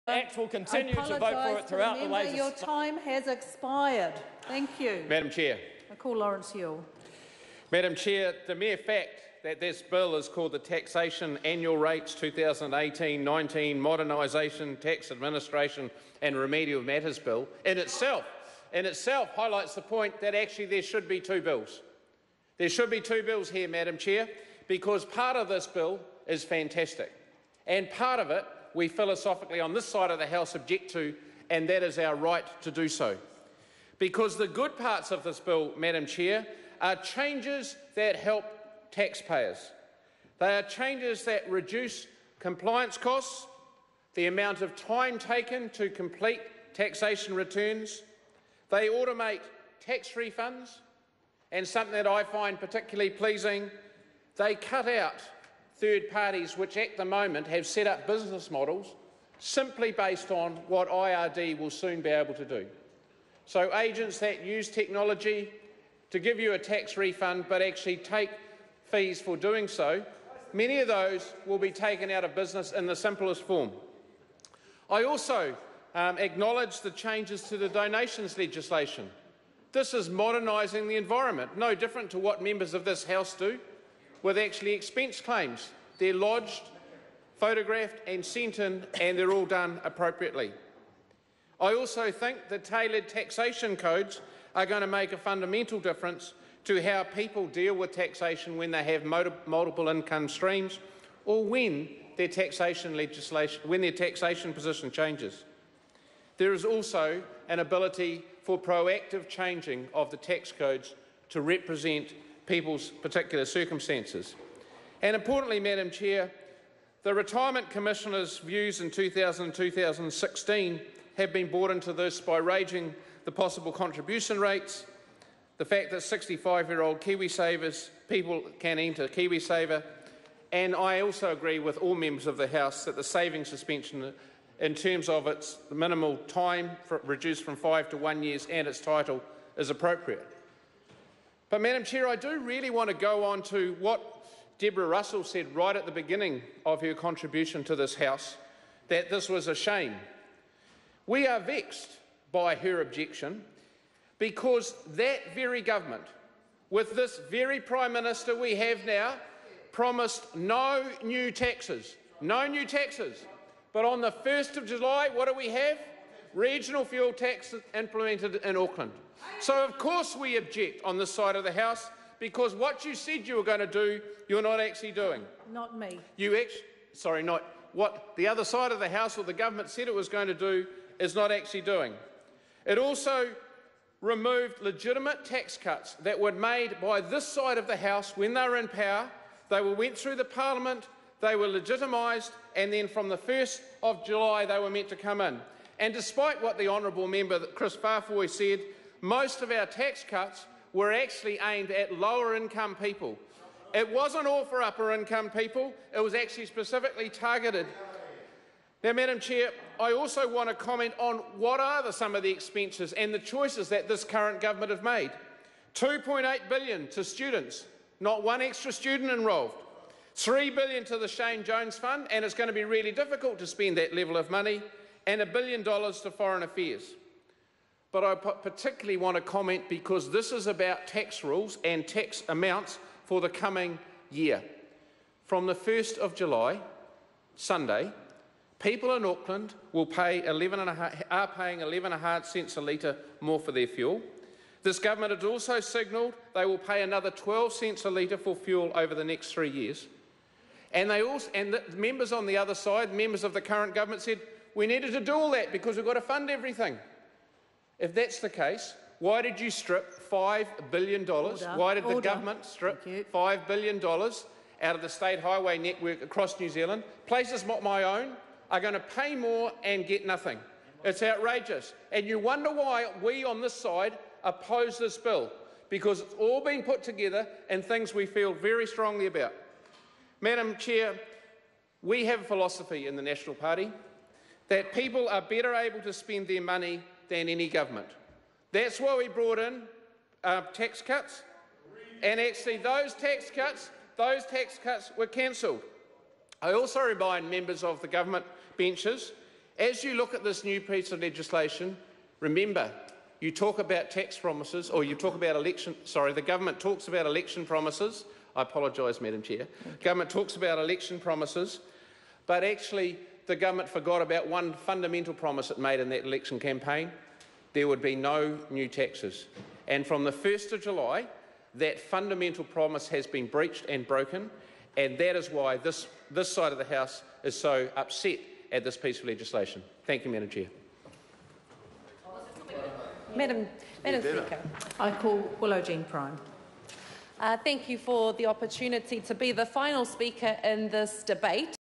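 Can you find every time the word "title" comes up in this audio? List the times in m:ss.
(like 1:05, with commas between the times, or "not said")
2:18.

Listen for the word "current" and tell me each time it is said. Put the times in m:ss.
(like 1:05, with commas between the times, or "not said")
3:34, 4:13.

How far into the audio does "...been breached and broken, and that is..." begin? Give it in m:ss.
5:23.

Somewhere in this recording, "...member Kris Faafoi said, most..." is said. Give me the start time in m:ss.
3:17.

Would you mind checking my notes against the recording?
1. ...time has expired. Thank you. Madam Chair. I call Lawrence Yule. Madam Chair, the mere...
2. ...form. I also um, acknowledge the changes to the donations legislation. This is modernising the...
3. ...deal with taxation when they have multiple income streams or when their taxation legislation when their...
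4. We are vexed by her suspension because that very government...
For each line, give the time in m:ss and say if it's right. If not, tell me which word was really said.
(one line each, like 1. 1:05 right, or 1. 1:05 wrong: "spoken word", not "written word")
1. 0:02 right
2. 1:13 right
3. 1:37 right
4. 2:31 wrong: "objection", not "suspension".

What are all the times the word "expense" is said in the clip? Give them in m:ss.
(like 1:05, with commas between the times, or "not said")
1:24, 3:32.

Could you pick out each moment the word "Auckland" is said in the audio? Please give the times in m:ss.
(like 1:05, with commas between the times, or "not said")
2:48, 3:59.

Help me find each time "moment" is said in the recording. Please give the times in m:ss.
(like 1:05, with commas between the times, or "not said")
0:57.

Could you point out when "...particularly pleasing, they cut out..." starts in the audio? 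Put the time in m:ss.
0:52.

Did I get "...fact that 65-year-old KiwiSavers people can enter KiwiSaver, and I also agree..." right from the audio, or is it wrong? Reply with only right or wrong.
right.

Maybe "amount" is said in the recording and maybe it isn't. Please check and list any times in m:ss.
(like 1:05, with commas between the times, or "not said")
0:44, 3:52.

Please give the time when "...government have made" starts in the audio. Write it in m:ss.
3:34.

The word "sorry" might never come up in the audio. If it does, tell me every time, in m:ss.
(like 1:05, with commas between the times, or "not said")
2:56, 5:05.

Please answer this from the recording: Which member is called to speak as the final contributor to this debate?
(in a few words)
Willow Jean Prime.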